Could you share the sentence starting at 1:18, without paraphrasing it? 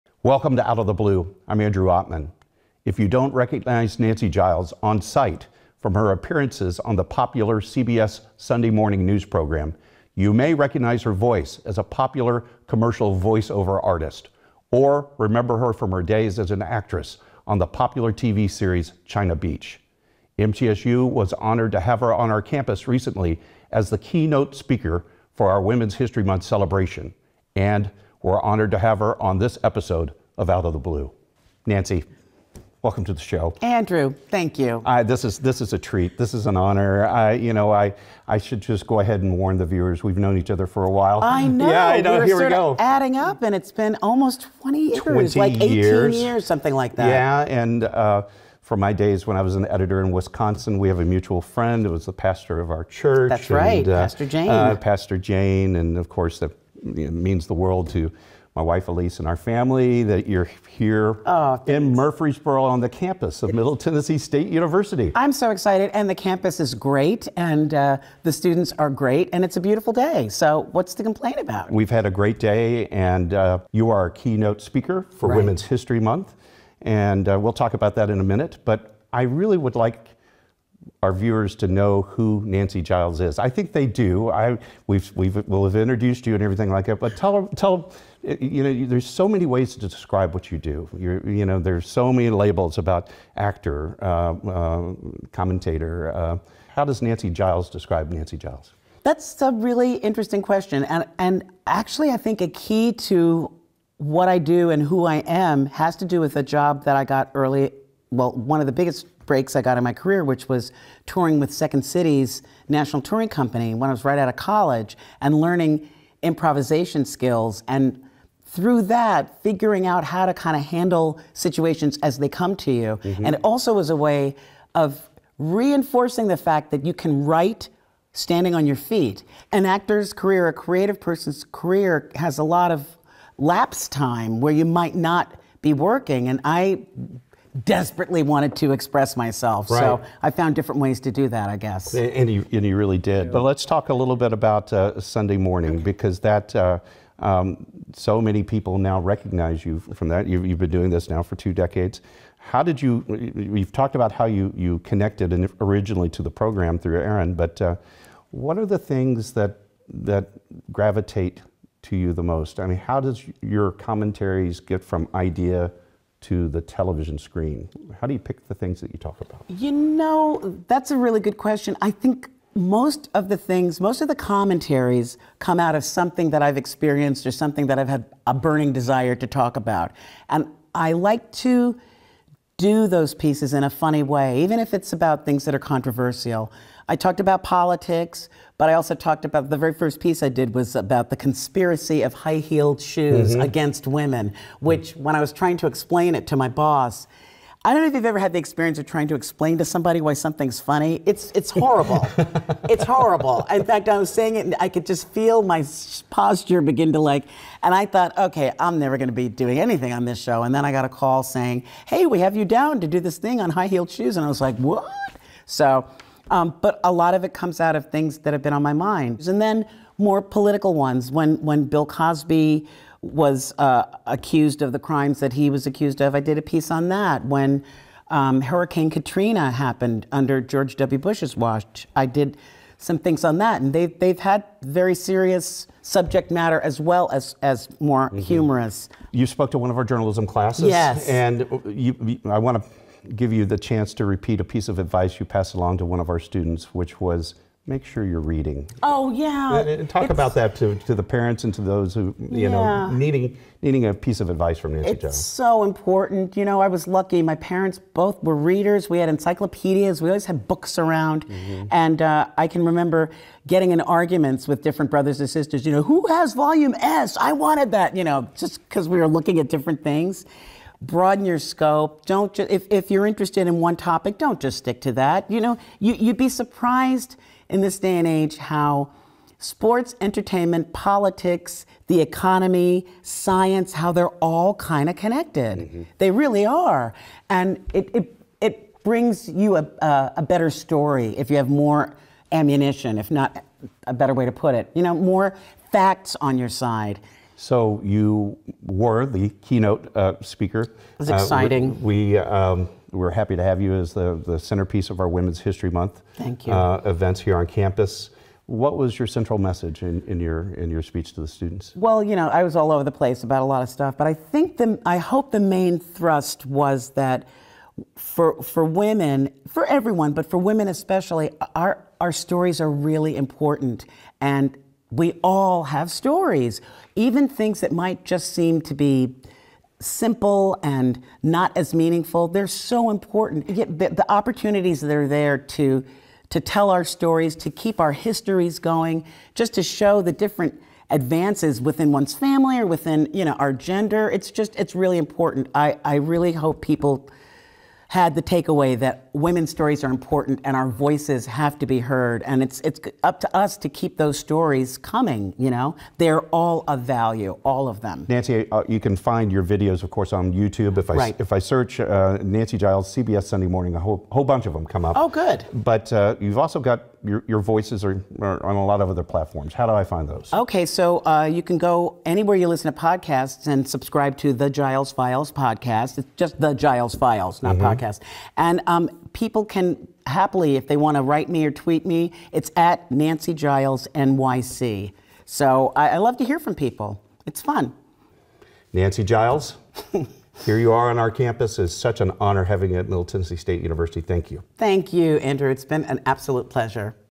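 But I really would like our viewers to know who Nancy Giles is.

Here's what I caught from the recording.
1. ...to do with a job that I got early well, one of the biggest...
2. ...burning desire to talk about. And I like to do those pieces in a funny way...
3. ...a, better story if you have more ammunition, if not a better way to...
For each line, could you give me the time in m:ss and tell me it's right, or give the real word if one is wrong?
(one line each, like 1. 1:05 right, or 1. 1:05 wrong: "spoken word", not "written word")
1. 1:45 right
2. 2:58 right
3. 4:50 right.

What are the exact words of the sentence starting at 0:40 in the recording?
We've known each other for a while.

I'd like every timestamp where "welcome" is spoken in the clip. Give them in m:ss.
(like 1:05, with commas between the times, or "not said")
0:00, 0:32.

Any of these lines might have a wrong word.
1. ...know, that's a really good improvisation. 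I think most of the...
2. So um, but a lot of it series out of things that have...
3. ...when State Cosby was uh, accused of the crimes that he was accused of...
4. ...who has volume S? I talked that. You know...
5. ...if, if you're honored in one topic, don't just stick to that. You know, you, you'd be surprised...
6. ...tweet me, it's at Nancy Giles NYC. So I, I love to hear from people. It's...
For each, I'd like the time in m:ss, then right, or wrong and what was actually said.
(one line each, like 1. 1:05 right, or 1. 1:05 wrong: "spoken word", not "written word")
1. 2:49 wrong: "question", not "improvisation"
2. 3:35 wrong: "comes", not "series"
3. 3:41 wrong: "Bill", not "State"
4. 4:25 wrong: "wanted", not "talked"
5. 4:32 wrong: "interested", not "honored"
6. 6:21 right.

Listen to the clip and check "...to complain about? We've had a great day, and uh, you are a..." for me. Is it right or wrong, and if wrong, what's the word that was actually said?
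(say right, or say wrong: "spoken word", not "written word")
right.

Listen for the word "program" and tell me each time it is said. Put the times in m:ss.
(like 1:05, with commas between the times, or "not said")
0:09, 2:36.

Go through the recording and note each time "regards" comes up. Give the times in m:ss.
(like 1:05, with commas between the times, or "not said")
not said.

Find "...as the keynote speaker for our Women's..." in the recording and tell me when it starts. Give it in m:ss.
0:23.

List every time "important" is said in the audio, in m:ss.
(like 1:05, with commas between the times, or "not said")
4:15, 5:23, 5:32, 5:44, 5:49.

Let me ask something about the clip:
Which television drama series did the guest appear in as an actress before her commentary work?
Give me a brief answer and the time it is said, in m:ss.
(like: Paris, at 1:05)
China Beach, at 0:19.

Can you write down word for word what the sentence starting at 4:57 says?
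So you were the keynote uh, speaker.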